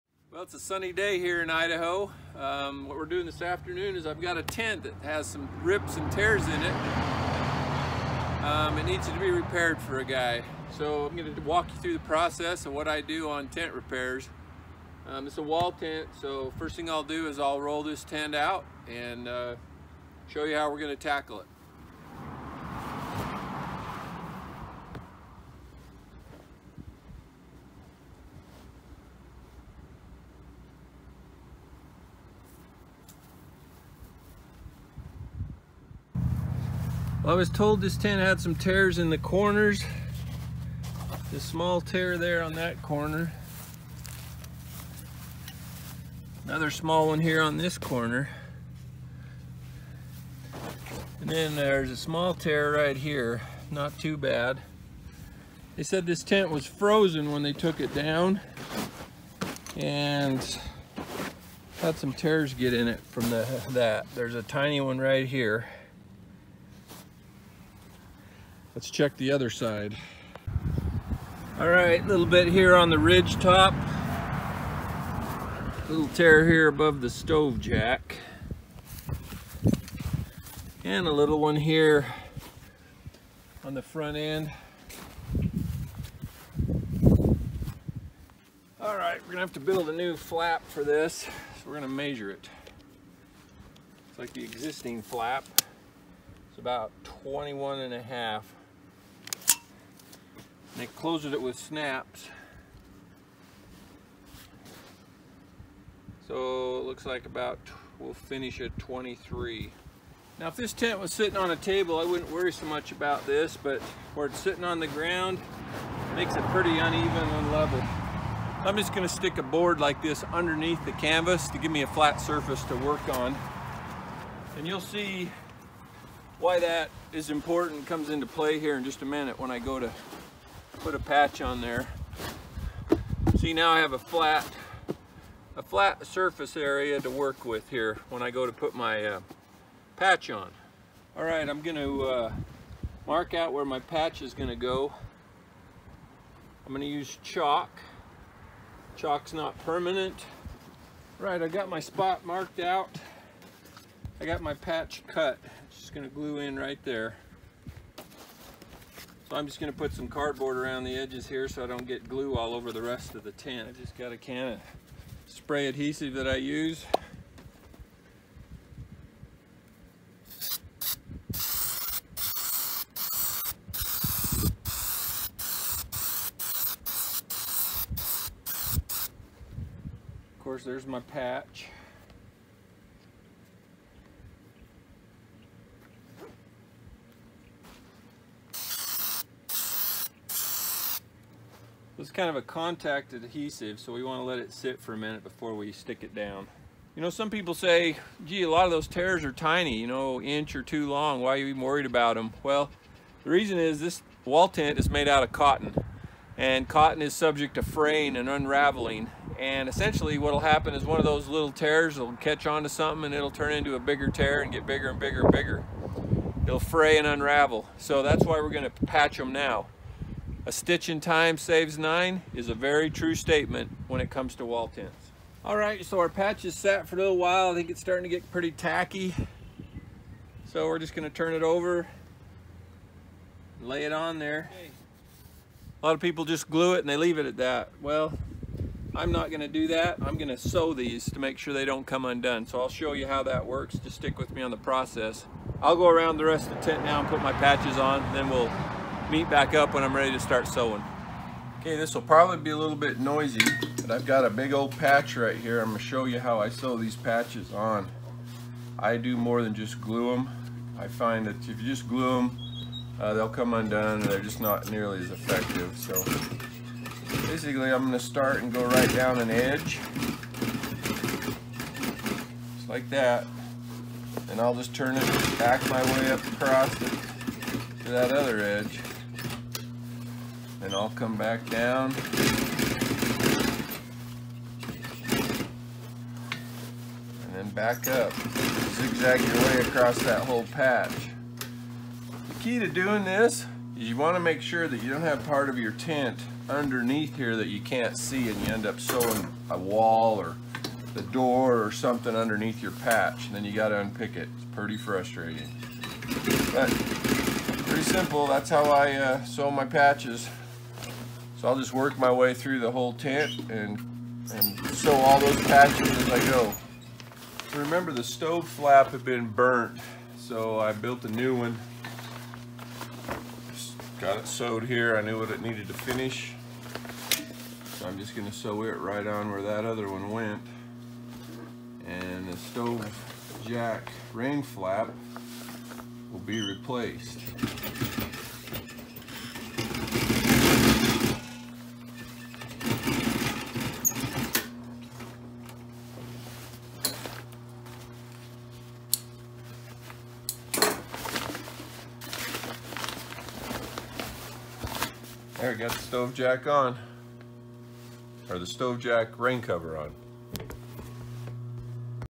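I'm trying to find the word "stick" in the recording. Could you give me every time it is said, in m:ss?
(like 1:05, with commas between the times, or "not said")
1:59, 3:15, 4:03.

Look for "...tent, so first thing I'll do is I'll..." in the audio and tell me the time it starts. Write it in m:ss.
0:15.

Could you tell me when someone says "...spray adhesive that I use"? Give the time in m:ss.
2:45.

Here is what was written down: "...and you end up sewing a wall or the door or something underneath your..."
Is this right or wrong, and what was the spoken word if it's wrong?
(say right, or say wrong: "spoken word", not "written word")
right.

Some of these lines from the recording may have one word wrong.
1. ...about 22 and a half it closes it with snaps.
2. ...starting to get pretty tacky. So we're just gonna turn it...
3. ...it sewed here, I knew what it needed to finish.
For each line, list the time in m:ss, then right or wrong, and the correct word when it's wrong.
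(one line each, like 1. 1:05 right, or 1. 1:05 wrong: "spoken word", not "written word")
1. 1:36 wrong: "21", not "22"
2. 3:47 right
3. 5:24 right.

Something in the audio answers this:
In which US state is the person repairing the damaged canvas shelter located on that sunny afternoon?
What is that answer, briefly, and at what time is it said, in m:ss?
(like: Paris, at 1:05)
Idaho, at 0:01.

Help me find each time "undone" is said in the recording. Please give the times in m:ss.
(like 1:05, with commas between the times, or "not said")
4:02, 4:23.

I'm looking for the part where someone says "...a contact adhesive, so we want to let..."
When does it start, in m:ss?
3:12.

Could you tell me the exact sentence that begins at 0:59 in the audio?
And had some tears get in it from the, that.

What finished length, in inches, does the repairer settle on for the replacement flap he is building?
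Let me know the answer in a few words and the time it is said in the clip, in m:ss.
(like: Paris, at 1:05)
23, at 1:48.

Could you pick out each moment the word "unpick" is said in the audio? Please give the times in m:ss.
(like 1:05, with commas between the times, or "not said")
5:03.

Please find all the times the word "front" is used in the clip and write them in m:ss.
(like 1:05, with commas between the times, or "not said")
1:23.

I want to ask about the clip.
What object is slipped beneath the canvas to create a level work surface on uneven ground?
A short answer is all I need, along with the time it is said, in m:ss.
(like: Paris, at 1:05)
A board, at 1:59.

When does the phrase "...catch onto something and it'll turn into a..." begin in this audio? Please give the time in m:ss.
3:32.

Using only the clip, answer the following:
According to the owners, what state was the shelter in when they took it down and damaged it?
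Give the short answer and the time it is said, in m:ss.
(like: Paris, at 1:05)
Frozen, at 0:56.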